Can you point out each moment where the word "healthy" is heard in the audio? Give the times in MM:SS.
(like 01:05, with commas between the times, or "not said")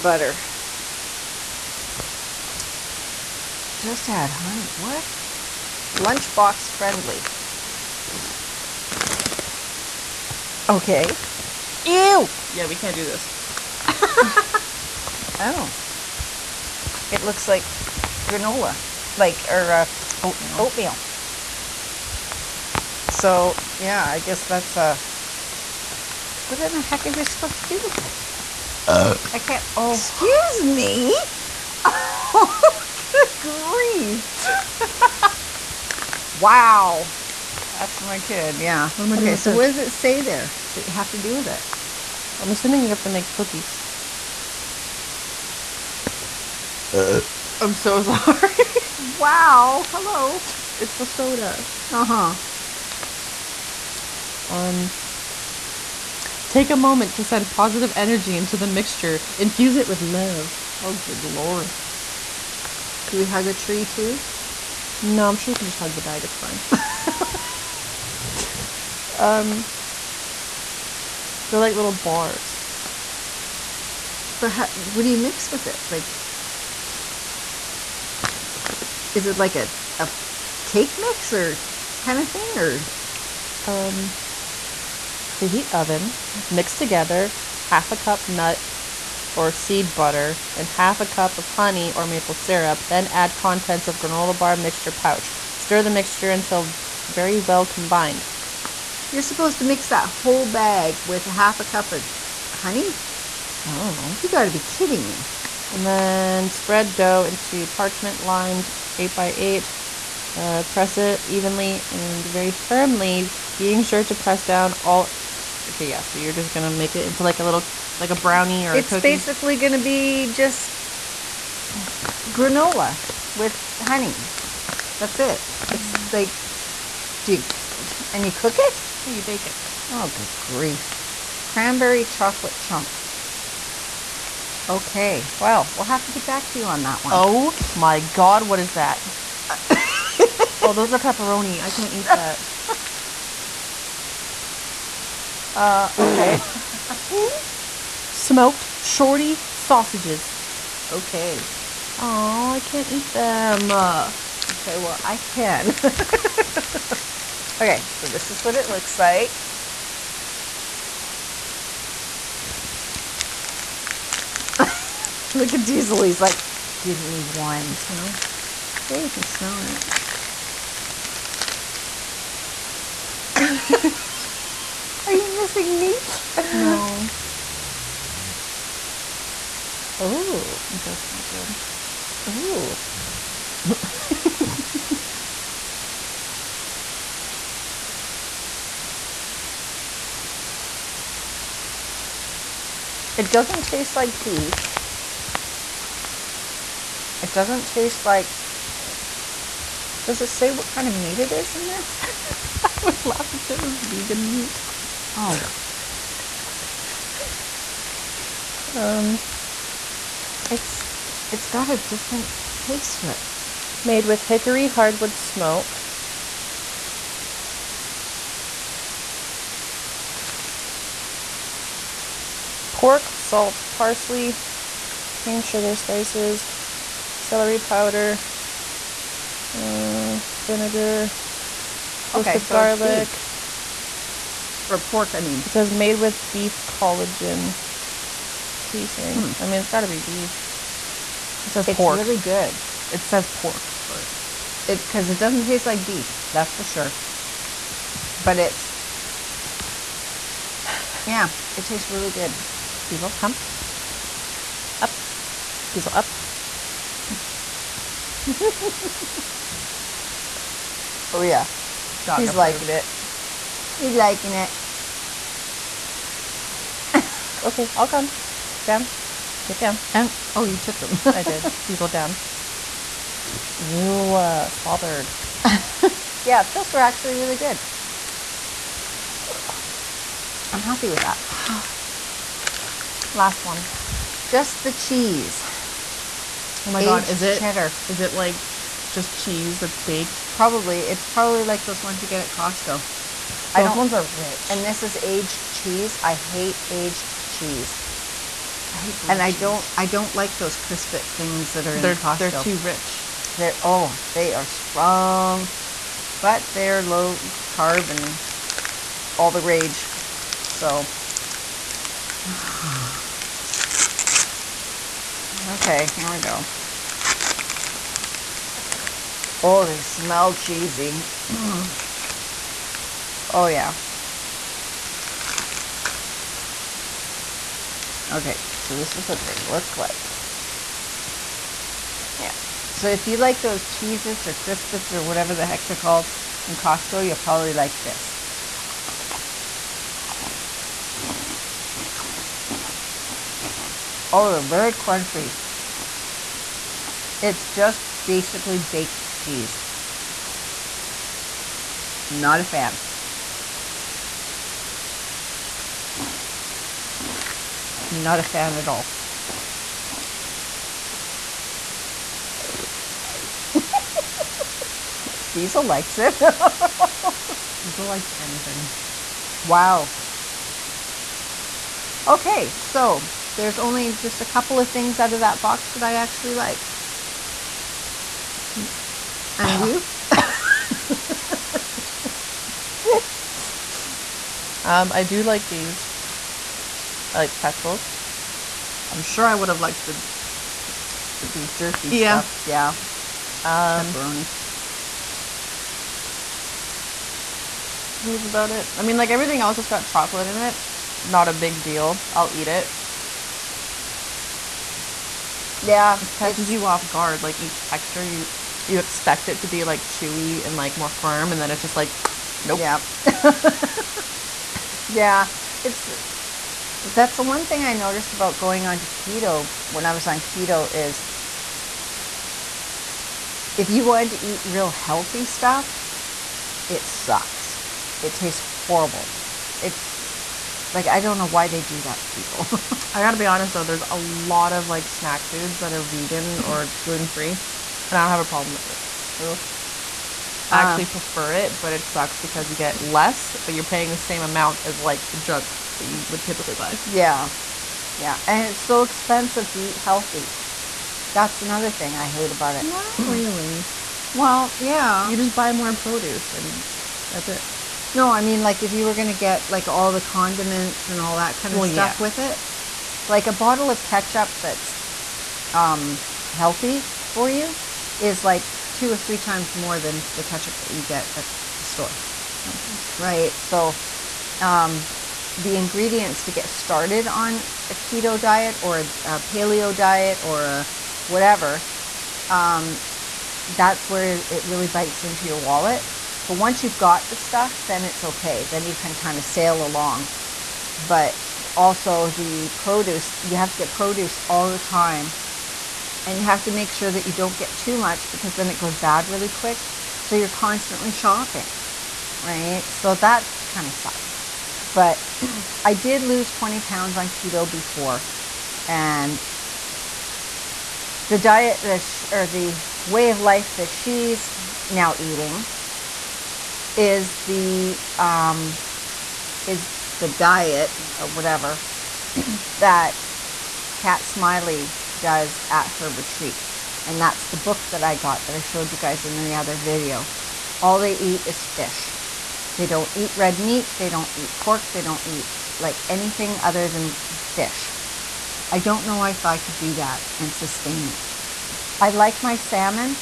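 07:04, 07:29, 07:46.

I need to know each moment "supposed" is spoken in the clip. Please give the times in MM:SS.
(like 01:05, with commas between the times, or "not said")
00:27, 01:39.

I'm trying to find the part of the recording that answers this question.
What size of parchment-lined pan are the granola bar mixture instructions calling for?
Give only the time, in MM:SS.
01:48.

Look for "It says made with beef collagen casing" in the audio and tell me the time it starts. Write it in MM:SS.
03:55.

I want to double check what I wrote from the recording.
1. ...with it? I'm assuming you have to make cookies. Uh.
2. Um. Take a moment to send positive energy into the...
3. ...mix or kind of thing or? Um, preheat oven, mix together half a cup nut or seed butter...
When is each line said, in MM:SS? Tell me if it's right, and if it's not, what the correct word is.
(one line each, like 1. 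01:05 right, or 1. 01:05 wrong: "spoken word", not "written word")
1. 00:41 right
2. 00:54 right
3. 01:20 right.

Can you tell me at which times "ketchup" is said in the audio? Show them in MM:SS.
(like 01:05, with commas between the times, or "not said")
07:43, 07:50.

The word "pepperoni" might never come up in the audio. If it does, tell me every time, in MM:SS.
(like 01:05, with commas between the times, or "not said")
02:20, 06:33.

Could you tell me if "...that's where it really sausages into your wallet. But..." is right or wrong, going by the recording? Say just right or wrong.
wrong.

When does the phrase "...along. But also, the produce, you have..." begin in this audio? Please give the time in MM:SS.
08:09.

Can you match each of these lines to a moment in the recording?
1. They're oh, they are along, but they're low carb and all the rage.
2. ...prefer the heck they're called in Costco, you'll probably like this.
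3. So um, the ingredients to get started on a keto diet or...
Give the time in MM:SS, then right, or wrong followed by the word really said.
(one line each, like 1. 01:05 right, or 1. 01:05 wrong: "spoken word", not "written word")
1. 05:03 wrong: "strong", not "along"
2. 05:35 wrong: "whatever", not "prefer"
3. 07:53 right.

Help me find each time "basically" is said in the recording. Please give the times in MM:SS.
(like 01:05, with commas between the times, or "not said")
01:58, 05:48.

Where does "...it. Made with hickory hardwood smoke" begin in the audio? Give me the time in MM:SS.
03:33.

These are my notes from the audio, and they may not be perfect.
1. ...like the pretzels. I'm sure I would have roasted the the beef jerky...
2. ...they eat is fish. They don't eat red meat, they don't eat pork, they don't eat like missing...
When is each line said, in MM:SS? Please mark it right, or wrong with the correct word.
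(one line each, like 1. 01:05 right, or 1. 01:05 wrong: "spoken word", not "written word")
1. 06:27 wrong: "liked", not "roasted"
2. 08:50 wrong: "anything", not "missing".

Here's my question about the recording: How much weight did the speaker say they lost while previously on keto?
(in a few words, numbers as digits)
20 pounds.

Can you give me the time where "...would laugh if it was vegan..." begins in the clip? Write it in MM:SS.
03:22.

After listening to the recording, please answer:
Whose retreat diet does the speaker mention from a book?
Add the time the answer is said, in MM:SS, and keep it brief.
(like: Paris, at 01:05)
Kat Smiley, at 08:43.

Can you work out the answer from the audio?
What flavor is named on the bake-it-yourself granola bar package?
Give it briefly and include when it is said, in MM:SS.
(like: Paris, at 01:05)
Cranberry chocolate chunk, at 02:11.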